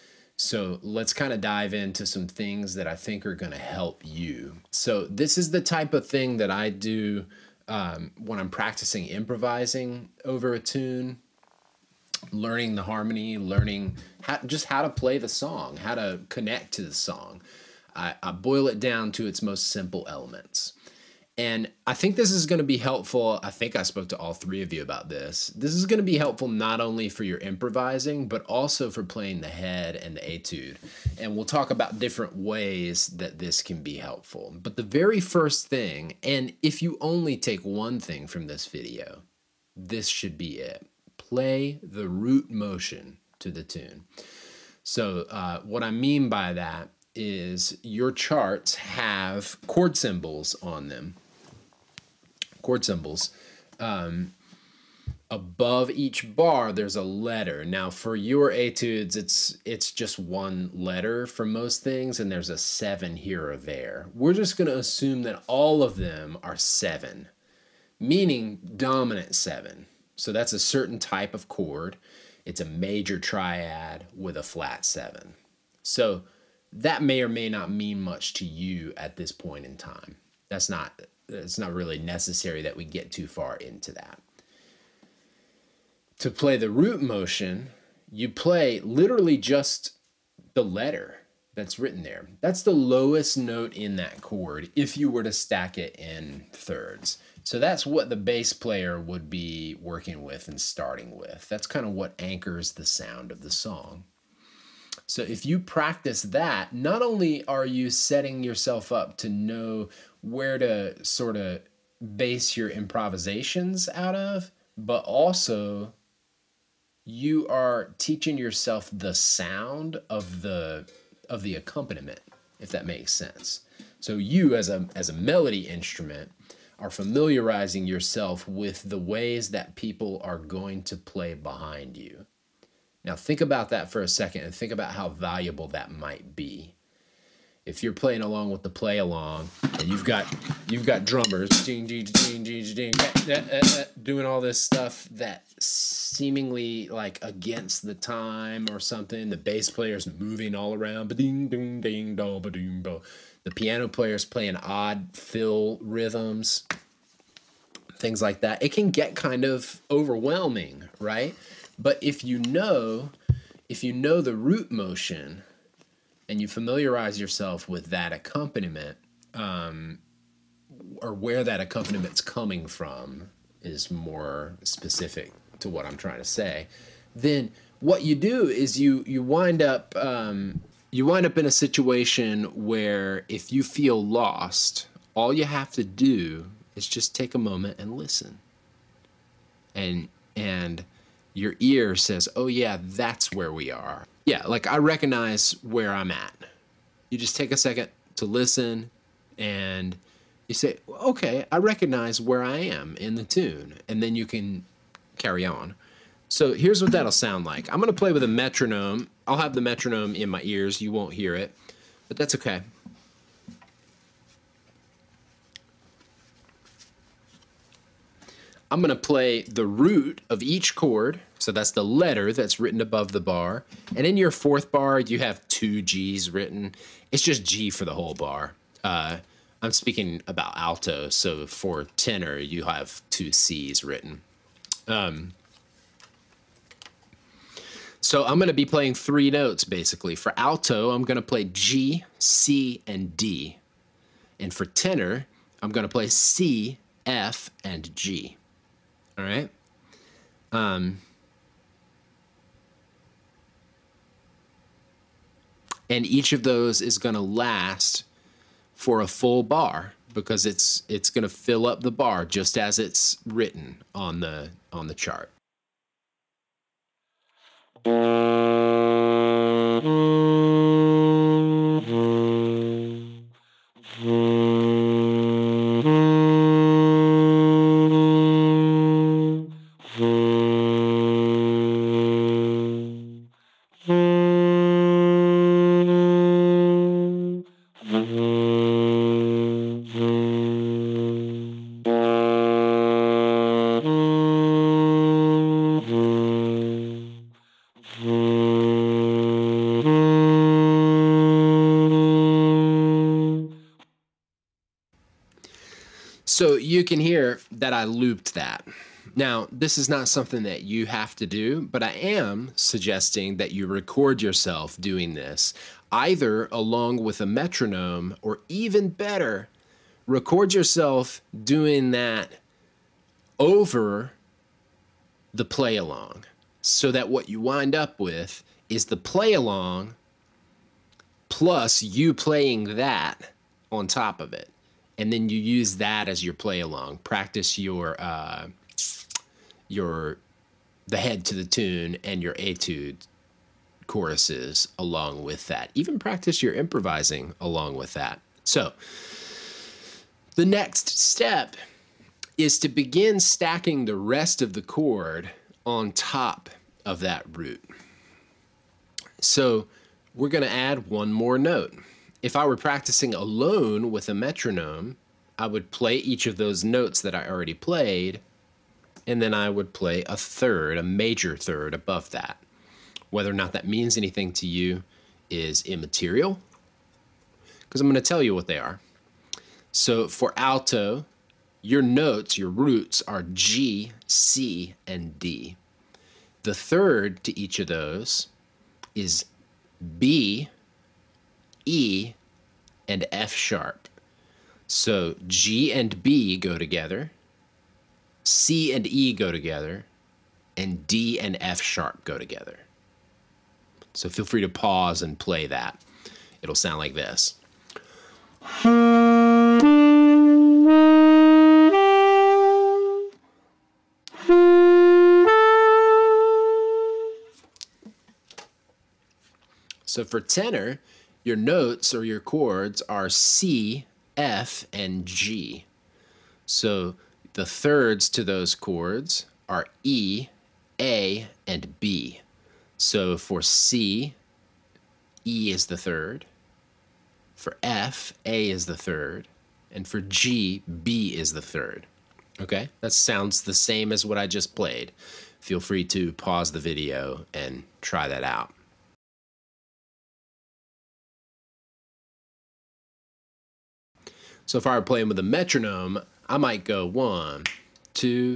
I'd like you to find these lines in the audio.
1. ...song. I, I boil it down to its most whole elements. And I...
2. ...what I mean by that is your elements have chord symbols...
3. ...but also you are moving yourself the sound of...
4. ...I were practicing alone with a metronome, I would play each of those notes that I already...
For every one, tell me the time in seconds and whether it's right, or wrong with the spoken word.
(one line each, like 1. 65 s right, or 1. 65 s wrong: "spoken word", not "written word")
1. 16 s wrong: "simple", not "whole"
2. 45 s wrong: "charts", not "elements"
3. 114 s wrong: "teaching", not "moving"
4. 362 s right.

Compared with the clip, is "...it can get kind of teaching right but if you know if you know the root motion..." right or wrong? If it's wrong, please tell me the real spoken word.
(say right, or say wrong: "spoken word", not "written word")
wrong: "overwhelming", not "teaching".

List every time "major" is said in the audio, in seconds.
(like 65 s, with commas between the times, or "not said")
72 s, 370 s.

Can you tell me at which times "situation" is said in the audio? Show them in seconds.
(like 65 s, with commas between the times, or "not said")
181 s.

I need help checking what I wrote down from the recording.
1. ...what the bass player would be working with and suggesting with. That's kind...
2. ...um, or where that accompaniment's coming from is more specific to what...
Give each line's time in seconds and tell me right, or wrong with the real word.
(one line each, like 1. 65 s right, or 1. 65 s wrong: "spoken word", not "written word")
1. 97 s wrong: "starting", not "suggesting"
2. 169 s right.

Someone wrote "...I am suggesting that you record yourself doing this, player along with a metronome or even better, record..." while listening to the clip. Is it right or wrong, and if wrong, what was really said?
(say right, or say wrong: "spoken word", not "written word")
wrong: "either", not "player".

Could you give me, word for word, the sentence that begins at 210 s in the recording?
You won't hear it, but that's okay.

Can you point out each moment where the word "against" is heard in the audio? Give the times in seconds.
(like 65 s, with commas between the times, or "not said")
147 s.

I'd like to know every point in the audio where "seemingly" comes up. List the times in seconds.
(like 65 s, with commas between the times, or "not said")
145 s.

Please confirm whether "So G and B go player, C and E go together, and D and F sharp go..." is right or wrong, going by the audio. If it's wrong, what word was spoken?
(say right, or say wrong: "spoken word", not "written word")
wrong: "together", not "player".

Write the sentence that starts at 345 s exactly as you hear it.
Even practice your improvising along with that.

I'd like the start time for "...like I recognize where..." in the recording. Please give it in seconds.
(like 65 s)
194 s.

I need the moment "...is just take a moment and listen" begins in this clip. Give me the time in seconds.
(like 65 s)
186 s.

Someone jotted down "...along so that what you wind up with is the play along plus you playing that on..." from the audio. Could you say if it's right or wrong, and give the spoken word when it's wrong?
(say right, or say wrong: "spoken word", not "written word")
right.